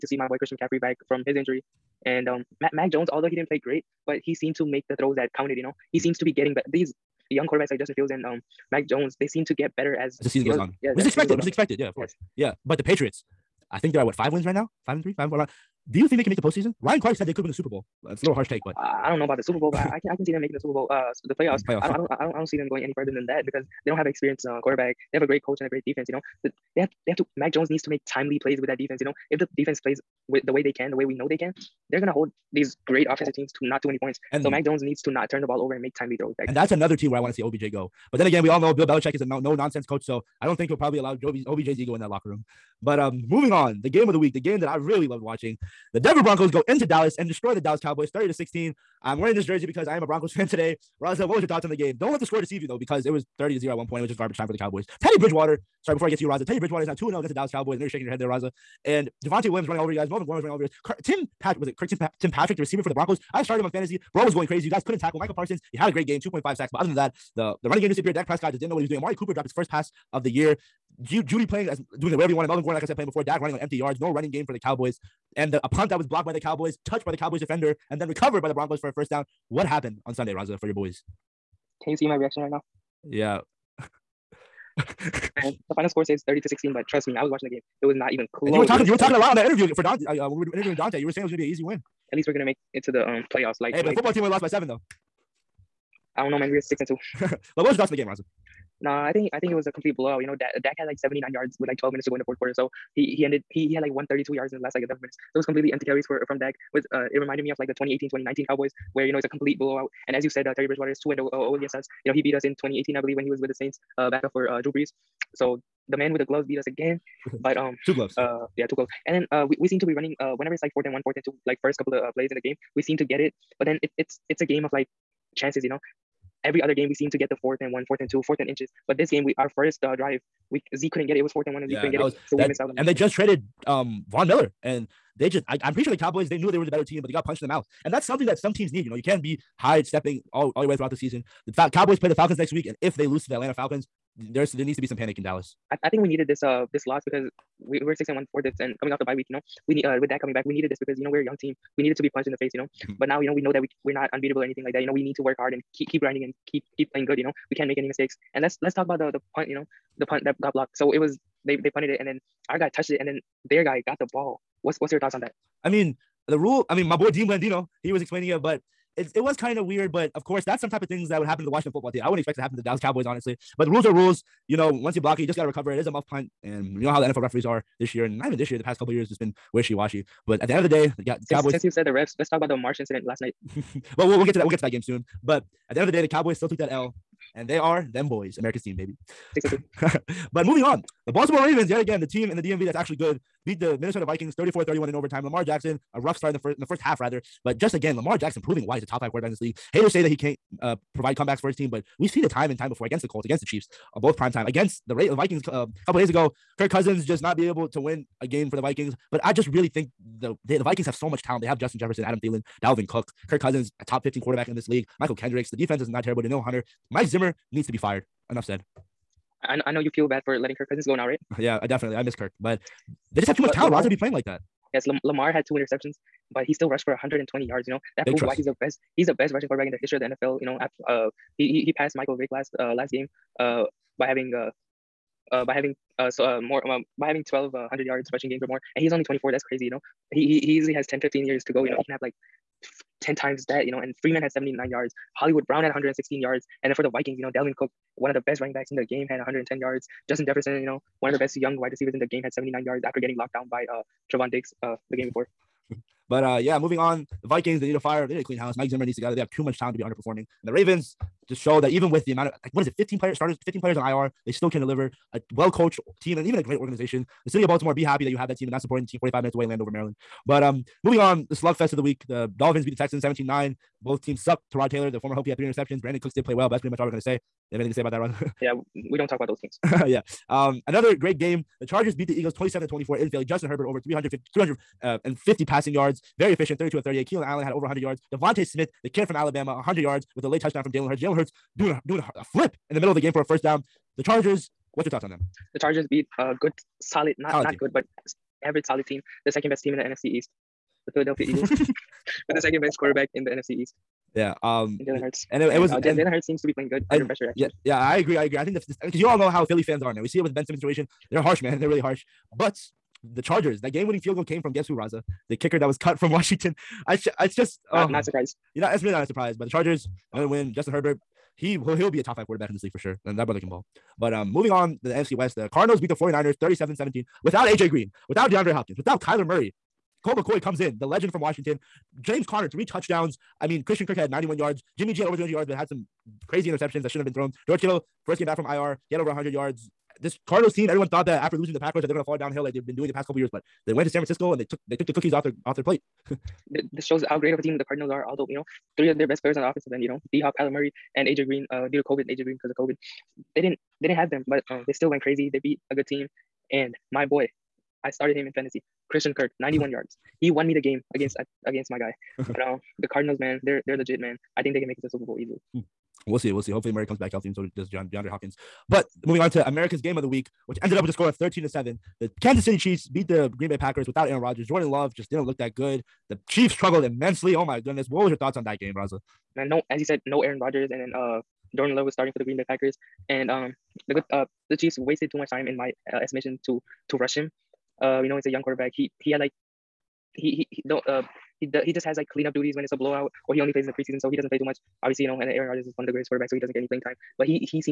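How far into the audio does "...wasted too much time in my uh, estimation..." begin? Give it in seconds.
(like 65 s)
384 s.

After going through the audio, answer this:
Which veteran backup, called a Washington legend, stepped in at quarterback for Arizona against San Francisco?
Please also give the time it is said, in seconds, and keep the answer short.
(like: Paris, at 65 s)
Colt McCoy, at 330 s.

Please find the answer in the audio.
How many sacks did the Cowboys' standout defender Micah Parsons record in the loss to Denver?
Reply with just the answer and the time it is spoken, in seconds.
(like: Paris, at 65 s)
2.5, at 66 s.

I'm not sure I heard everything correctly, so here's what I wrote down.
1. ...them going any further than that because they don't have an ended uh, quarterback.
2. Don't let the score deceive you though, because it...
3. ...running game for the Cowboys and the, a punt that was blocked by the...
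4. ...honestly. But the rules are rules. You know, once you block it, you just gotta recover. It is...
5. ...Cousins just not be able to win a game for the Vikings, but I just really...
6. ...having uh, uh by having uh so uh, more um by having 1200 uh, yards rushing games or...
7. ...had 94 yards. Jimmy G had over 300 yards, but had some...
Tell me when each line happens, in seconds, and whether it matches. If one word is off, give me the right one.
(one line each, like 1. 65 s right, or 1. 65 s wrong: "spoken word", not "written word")
1. 22 s wrong: "experienced", not "ended"
2. 51 s right
3. 74 s right
4. 173 s right
5. 206 s right
6. 234 s right
7. 333 s wrong: "91", not "94".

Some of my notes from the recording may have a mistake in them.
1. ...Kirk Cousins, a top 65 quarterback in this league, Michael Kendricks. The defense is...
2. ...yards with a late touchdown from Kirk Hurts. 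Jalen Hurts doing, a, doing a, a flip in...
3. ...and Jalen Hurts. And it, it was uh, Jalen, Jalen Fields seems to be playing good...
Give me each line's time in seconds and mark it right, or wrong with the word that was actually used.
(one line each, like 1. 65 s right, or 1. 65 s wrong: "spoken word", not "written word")
1. 213 s wrong: "15", not "65"
2. 289 s wrong: "Jalen", not "Kirk"
3. 304 s wrong: "Hurts", not "Fields".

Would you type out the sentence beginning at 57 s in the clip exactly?
I know you're shaking your head there, Raza.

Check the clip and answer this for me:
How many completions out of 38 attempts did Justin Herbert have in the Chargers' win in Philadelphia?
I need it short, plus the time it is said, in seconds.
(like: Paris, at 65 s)
32, at 286 s.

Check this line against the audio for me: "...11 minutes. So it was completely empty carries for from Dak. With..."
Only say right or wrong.
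right.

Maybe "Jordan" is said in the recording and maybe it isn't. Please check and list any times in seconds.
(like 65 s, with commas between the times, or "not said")
374 s, 381 s.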